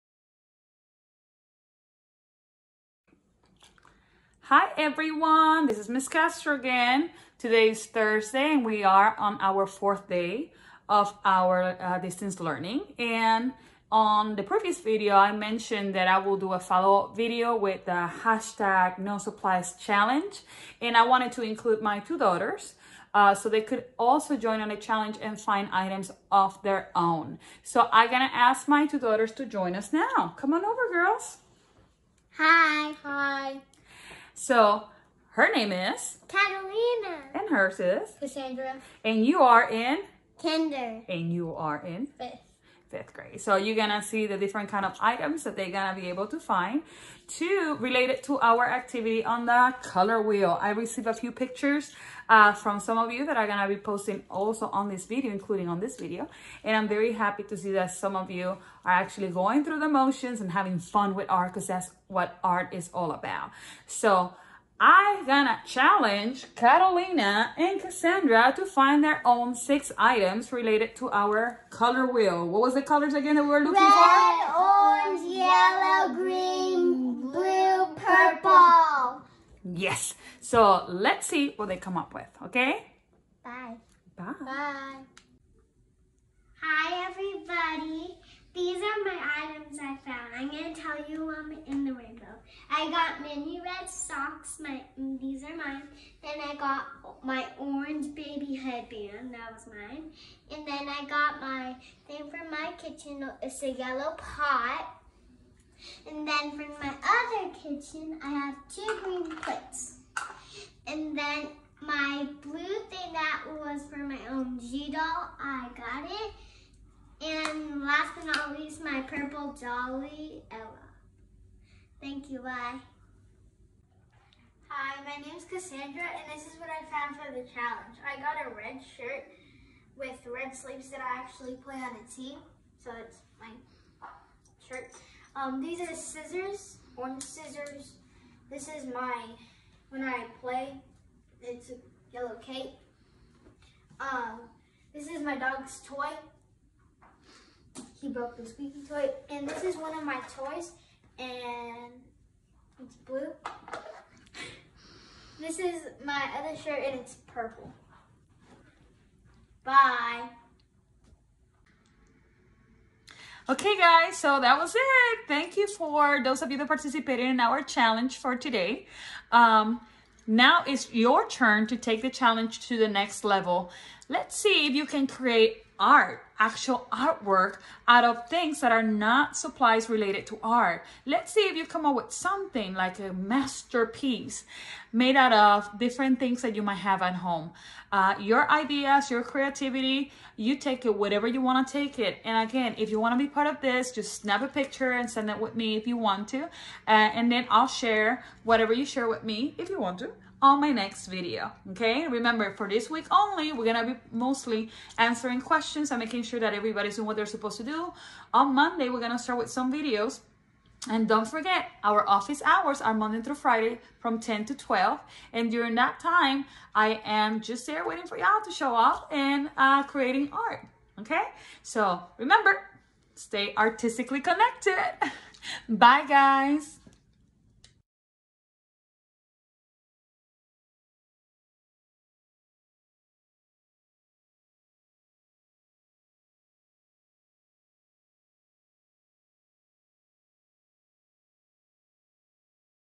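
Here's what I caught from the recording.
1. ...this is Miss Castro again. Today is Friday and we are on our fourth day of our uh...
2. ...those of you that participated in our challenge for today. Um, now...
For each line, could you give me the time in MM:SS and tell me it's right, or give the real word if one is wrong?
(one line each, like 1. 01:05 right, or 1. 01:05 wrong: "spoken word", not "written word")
1. 00:05 wrong: "Thursday", not "Friday"
2. 02:46 right.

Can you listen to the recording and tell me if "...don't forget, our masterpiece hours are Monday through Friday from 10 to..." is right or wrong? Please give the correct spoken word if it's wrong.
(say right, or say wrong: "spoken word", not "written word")
wrong: "office", not "masterpiece".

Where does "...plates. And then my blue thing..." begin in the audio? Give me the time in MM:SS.
01:49.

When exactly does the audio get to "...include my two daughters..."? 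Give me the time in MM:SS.
00:21.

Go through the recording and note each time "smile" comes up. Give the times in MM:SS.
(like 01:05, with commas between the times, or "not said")
not said.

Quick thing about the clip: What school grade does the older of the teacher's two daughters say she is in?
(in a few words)
Fifth grade.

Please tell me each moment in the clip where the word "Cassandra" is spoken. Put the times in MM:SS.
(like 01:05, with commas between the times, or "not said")
00:38, 01:07, 02:05.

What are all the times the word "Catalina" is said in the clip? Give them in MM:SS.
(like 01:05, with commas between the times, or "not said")
00:36, 01:06.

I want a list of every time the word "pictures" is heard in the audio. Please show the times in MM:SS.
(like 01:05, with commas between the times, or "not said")
00:51, 03:14.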